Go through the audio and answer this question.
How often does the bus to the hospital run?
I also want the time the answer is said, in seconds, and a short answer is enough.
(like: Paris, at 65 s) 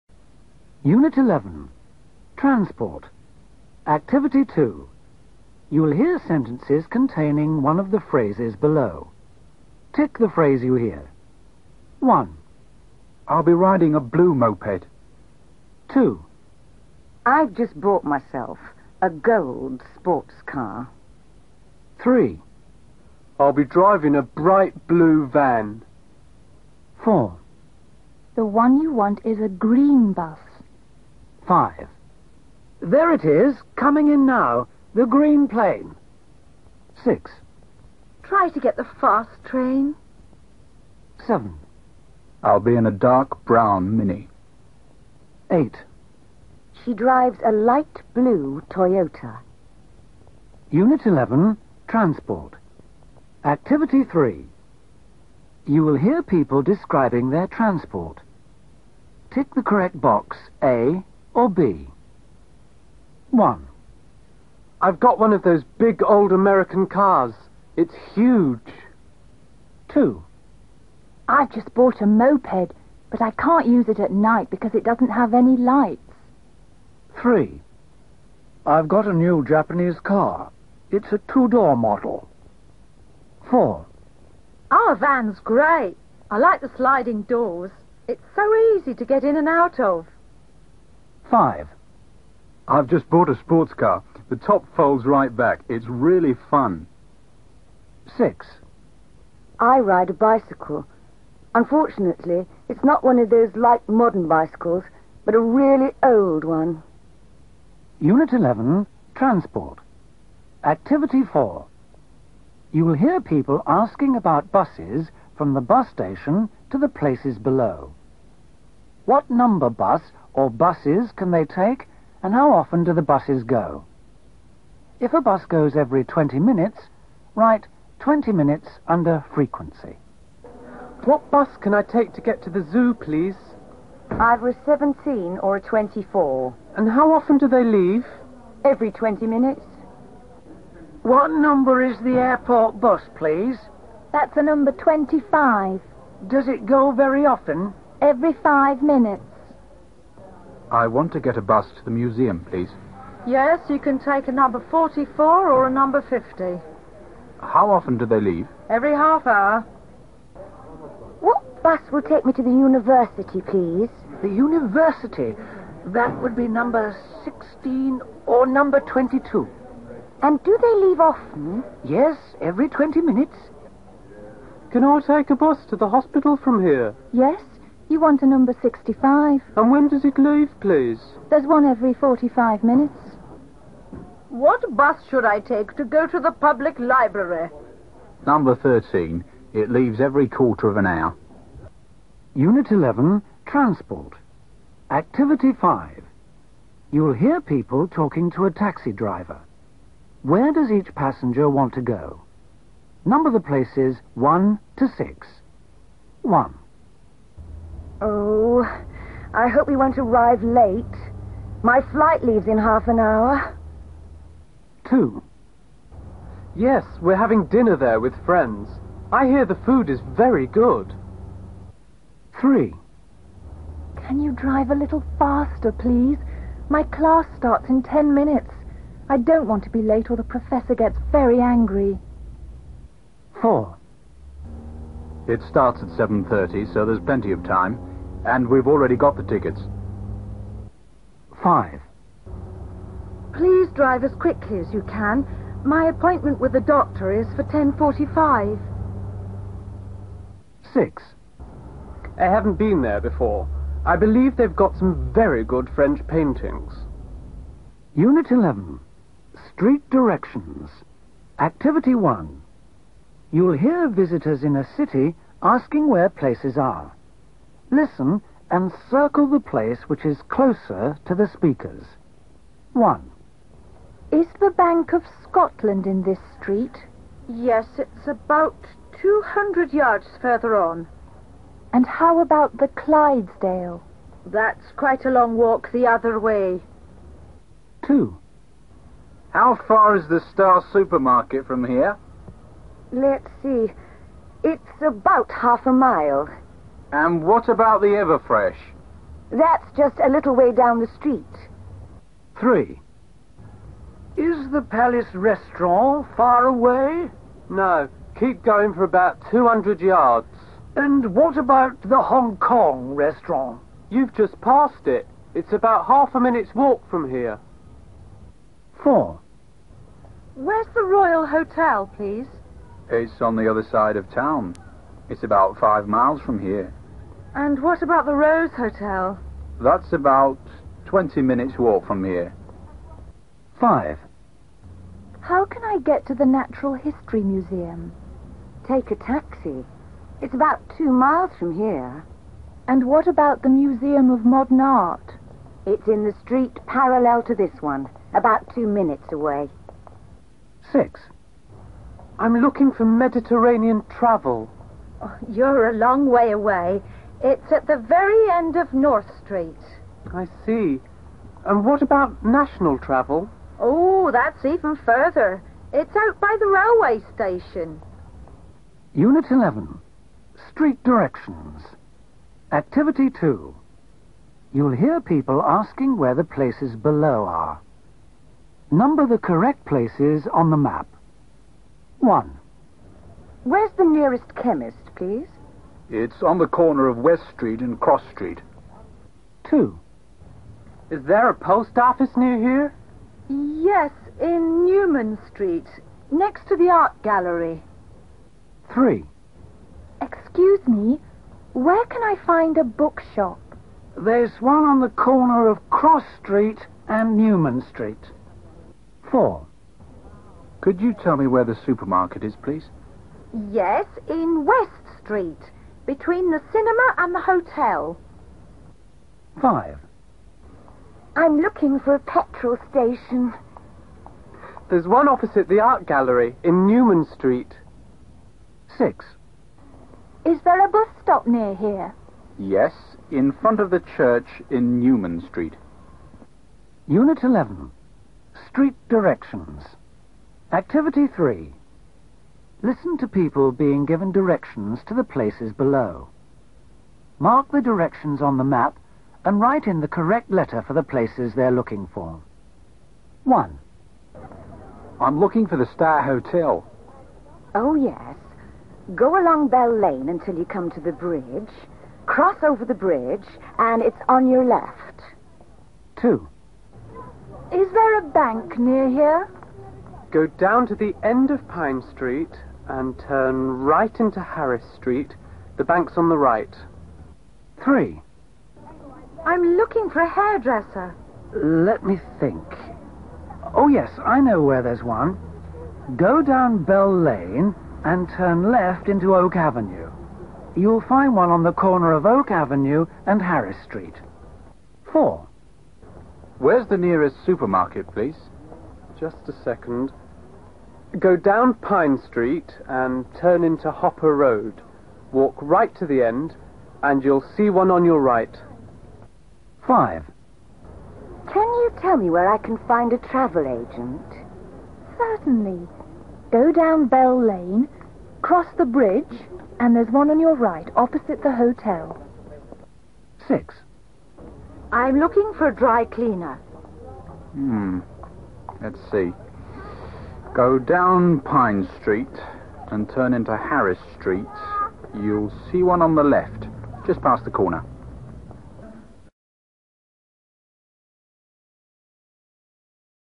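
every 45 minutes, at 181 s.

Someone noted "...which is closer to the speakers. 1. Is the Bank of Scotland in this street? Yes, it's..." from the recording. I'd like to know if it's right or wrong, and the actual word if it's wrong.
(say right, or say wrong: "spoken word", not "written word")
right.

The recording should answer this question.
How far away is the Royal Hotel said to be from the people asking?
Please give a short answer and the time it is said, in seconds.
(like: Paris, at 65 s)
five miles, at 325 s.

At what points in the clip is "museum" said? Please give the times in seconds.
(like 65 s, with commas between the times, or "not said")
151 s, 337 s, 343 s.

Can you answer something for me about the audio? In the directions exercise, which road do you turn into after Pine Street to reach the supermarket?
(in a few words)
Hopper Road.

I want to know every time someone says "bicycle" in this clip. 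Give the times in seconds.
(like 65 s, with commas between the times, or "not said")
100 s, 104 s.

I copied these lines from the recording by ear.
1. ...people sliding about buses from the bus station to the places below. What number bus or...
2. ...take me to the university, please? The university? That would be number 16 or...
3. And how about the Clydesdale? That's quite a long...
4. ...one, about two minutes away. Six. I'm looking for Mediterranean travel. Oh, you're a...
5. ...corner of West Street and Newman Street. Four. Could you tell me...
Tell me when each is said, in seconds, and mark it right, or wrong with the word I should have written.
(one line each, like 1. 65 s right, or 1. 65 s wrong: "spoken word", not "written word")
1. 113 s wrong: "asking", not "sliding"
2. 162 s right
3. 281 s right
4. 347 s right
5. 404 s wrong: "Cross", not "West".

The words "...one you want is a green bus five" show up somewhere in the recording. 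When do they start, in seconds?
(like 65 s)
28 s.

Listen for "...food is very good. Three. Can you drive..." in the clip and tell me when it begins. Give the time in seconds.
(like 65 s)
219 s.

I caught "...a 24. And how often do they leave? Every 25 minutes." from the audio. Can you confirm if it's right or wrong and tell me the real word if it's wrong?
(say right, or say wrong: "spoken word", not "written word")
wrong: "20", not "25".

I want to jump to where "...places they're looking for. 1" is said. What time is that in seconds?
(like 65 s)
450 s.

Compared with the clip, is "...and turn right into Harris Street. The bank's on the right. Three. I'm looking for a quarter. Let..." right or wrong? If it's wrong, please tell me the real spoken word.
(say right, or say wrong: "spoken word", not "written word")
wrong: "hairdresser", not "quarter".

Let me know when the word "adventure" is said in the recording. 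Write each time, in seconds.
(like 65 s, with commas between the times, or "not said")
not said.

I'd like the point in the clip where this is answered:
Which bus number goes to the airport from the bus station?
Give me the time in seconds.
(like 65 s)
144 s.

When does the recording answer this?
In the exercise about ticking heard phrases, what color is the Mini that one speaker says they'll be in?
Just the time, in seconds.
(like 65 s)
43 s.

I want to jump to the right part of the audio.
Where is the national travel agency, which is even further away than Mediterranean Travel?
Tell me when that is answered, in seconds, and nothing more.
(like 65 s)
366 s.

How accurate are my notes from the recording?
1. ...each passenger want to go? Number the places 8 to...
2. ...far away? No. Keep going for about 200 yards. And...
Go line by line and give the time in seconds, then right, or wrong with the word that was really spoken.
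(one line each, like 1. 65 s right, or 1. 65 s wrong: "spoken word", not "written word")
1. 200 s wrong: "1", not "8"
2. 306 s right.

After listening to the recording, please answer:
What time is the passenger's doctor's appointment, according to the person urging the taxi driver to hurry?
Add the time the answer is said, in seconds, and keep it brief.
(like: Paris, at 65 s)
10.45, at 247 s.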